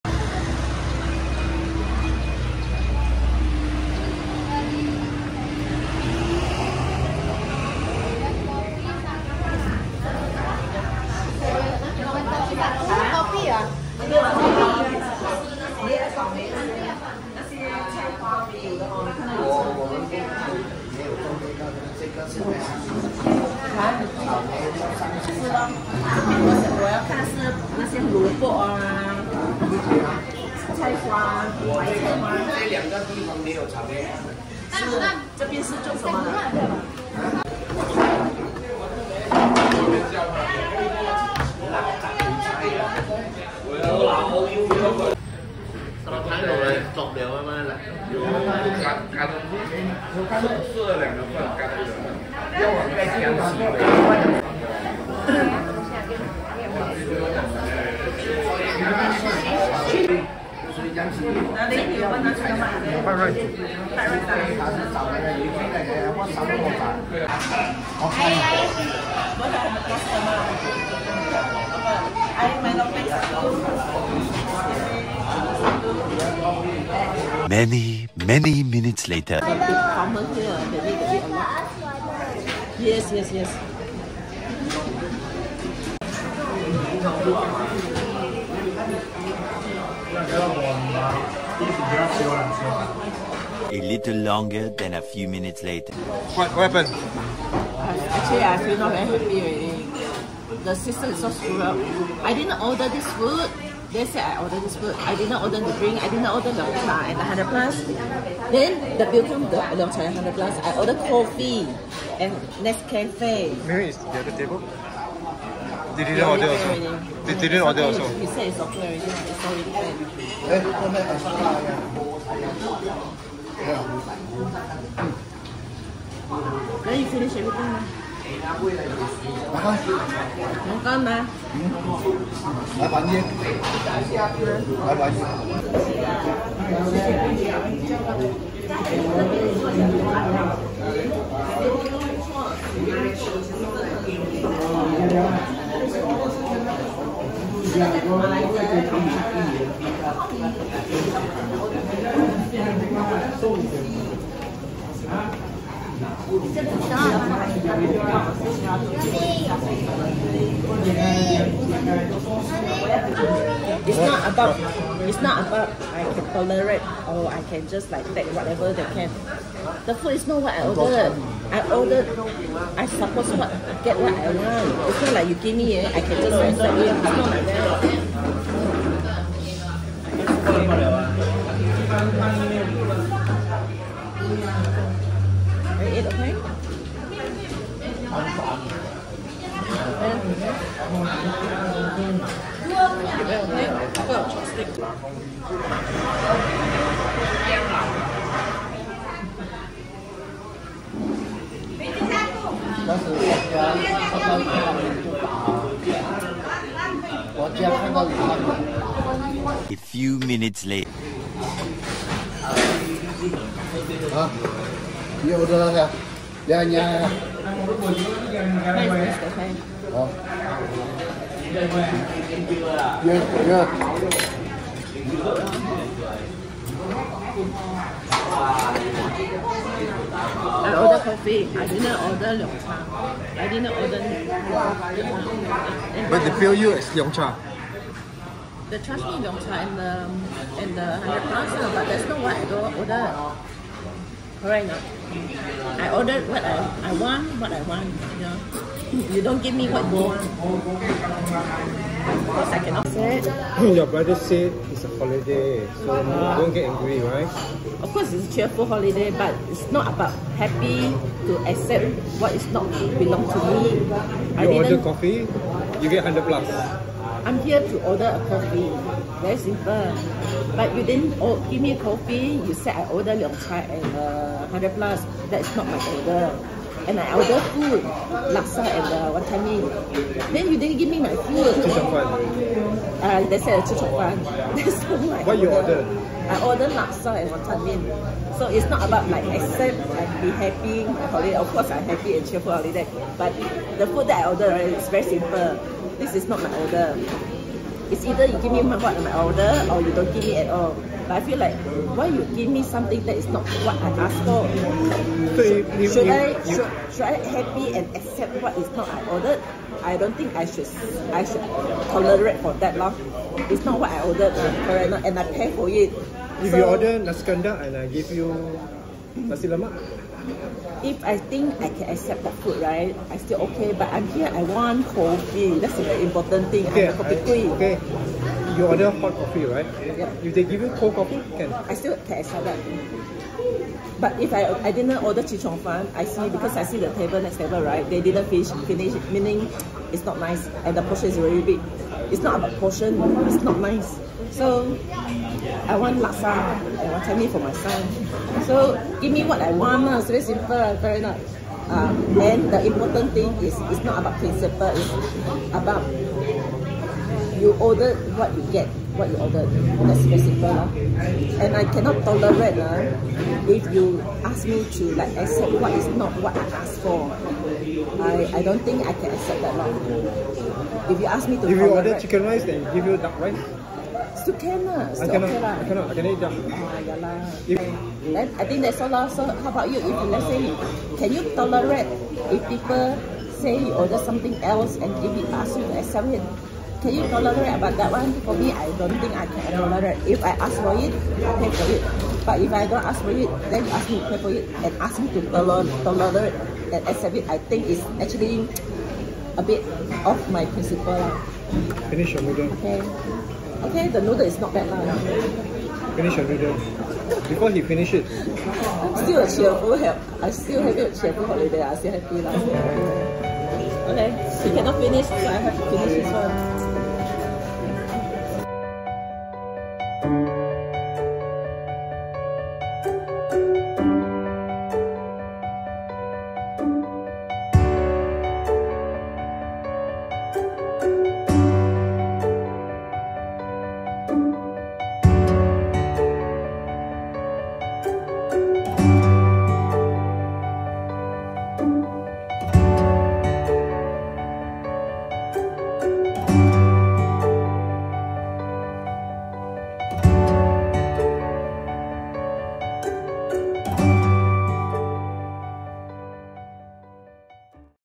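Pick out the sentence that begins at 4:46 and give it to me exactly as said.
I ordered laksa and wonton mee.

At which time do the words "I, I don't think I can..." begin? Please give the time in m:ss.
6:08.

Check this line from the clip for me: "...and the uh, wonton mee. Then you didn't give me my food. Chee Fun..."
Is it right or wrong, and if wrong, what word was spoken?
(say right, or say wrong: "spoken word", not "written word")
wrong: "Cheong", not "Fun".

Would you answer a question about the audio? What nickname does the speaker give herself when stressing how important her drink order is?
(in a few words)
coffee queen.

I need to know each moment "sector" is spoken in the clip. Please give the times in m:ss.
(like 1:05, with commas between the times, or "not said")
not said.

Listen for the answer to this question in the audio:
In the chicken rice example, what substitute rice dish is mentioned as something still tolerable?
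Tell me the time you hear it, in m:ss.
6:12.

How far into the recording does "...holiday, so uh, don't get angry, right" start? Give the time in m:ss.
4:14.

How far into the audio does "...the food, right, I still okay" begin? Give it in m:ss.
5:22.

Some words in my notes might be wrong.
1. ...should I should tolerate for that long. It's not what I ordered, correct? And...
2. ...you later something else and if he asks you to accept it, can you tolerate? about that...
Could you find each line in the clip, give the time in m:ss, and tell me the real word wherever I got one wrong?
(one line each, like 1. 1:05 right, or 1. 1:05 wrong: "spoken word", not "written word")
1. 5:10 right
2. 6:23 wrong: "order", not "later".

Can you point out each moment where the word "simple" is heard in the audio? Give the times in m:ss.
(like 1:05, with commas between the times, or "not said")
4:29, 4:55, 5:50, 6:00.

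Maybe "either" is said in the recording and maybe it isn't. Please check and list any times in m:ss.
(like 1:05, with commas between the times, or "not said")
4:58.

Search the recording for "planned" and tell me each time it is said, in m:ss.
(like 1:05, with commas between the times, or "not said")
1:59.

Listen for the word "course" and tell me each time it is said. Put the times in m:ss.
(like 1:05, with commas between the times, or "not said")
4:17, 4:51.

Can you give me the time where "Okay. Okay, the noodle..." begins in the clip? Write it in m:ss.
6:42.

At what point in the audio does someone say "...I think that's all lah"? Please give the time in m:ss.
6:18.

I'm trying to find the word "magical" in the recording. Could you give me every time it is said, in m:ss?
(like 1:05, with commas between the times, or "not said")
not said.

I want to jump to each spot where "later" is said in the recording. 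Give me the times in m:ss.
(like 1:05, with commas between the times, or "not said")
1:19, 1:35, 3:30.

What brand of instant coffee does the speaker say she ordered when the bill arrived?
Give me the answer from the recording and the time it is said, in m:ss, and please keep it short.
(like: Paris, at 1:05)
Nescafé, at 1:52.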